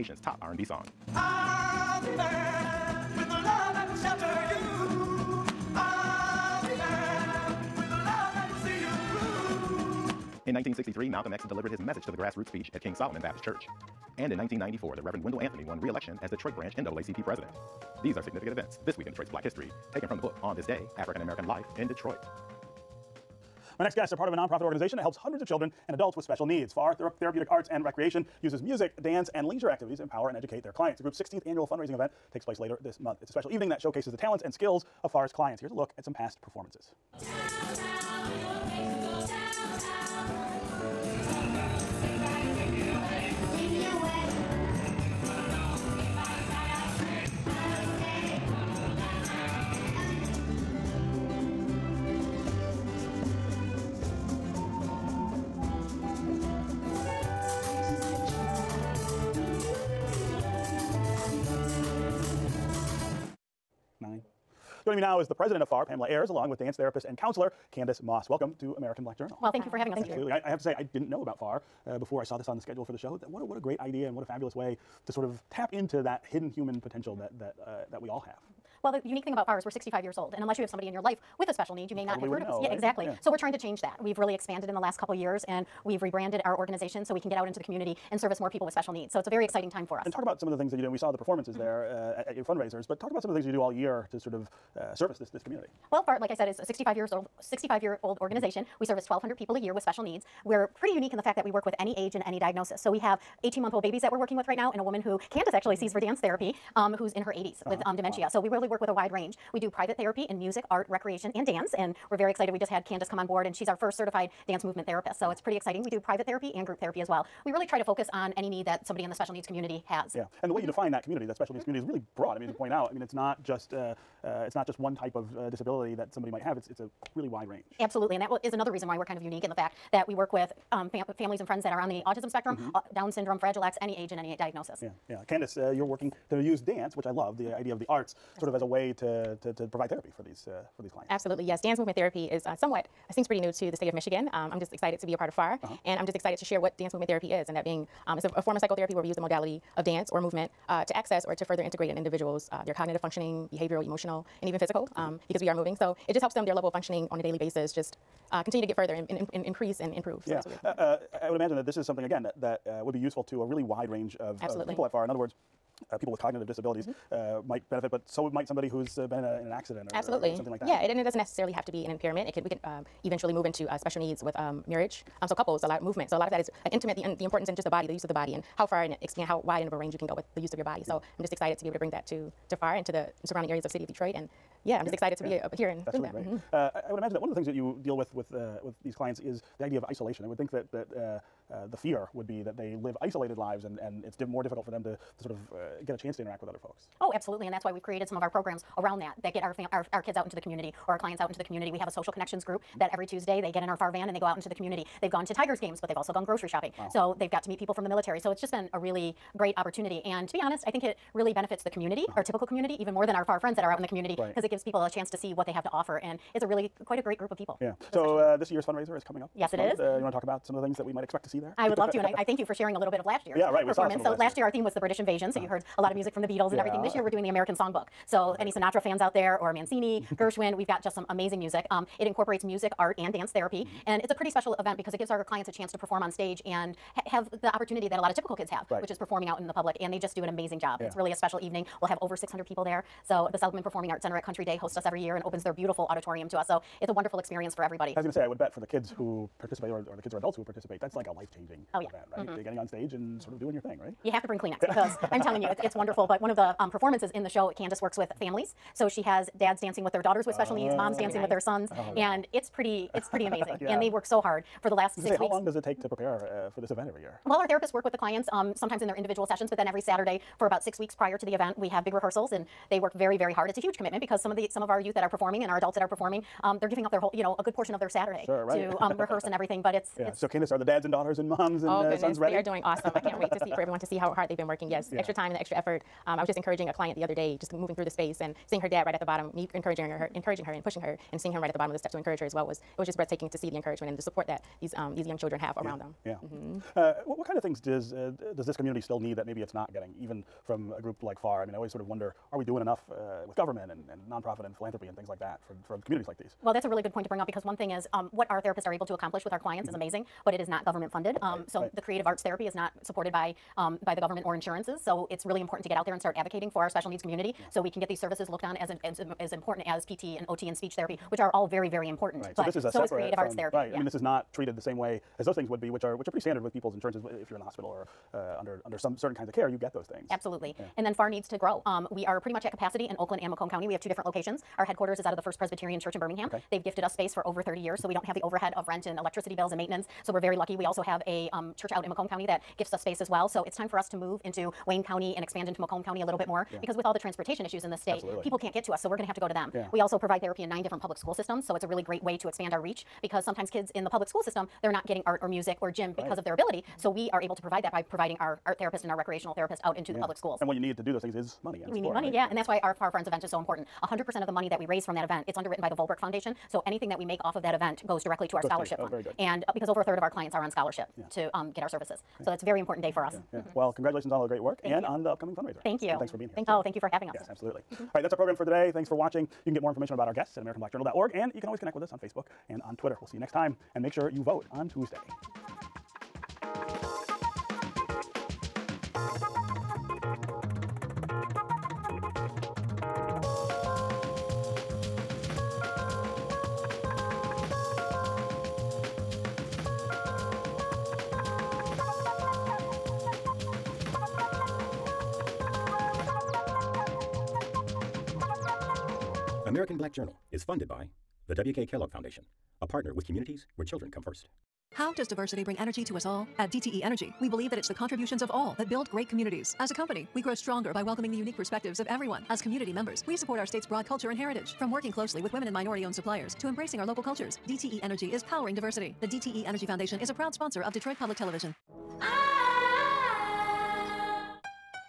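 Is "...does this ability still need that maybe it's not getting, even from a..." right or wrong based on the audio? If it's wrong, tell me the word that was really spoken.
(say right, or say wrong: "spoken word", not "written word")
wrong: "community", not "ability".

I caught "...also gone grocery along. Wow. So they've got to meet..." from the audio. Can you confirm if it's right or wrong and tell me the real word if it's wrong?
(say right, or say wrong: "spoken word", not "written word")
wrong: "shopping", not "along".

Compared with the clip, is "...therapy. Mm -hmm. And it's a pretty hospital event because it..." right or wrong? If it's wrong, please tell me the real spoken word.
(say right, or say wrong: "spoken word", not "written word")
wrong: "special", not "hospital".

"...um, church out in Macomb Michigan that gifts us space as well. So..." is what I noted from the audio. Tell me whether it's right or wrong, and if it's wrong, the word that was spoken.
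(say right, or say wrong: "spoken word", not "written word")
wrong: "County", not "Michigan".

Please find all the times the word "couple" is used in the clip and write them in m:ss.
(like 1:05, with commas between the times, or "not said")
1:24, 2:55.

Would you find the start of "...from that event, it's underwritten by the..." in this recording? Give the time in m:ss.
6:04.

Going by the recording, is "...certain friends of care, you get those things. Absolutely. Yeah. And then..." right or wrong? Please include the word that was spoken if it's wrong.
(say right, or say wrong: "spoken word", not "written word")
wrong: "kinds", not "friends".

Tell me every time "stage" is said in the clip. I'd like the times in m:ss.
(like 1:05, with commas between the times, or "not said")
3:56, 4:12.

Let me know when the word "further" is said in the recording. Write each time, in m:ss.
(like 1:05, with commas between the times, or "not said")
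2:31, 2:38.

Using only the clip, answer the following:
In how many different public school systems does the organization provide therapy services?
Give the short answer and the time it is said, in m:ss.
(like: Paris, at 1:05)
9, at 5:50.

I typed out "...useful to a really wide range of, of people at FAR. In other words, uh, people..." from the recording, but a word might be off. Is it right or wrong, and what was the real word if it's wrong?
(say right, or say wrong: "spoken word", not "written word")
right.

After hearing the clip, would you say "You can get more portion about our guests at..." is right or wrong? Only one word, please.
wrong.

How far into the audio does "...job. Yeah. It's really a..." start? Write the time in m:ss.
4:00.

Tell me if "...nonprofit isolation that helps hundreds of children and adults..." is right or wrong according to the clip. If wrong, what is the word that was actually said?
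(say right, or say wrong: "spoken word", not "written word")
wrong: "organization", not "isolation".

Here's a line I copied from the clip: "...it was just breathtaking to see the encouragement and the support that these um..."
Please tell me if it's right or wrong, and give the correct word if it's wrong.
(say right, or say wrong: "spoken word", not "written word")
right.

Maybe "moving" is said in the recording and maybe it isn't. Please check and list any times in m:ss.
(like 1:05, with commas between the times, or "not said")
2:35, 4:47.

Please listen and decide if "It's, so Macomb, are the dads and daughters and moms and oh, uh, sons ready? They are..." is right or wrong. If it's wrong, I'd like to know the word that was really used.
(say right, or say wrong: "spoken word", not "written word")
wrong: "Kandice", not "Macomb".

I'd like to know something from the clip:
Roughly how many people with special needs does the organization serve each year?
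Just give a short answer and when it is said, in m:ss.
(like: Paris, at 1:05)
1,200, at 1:39.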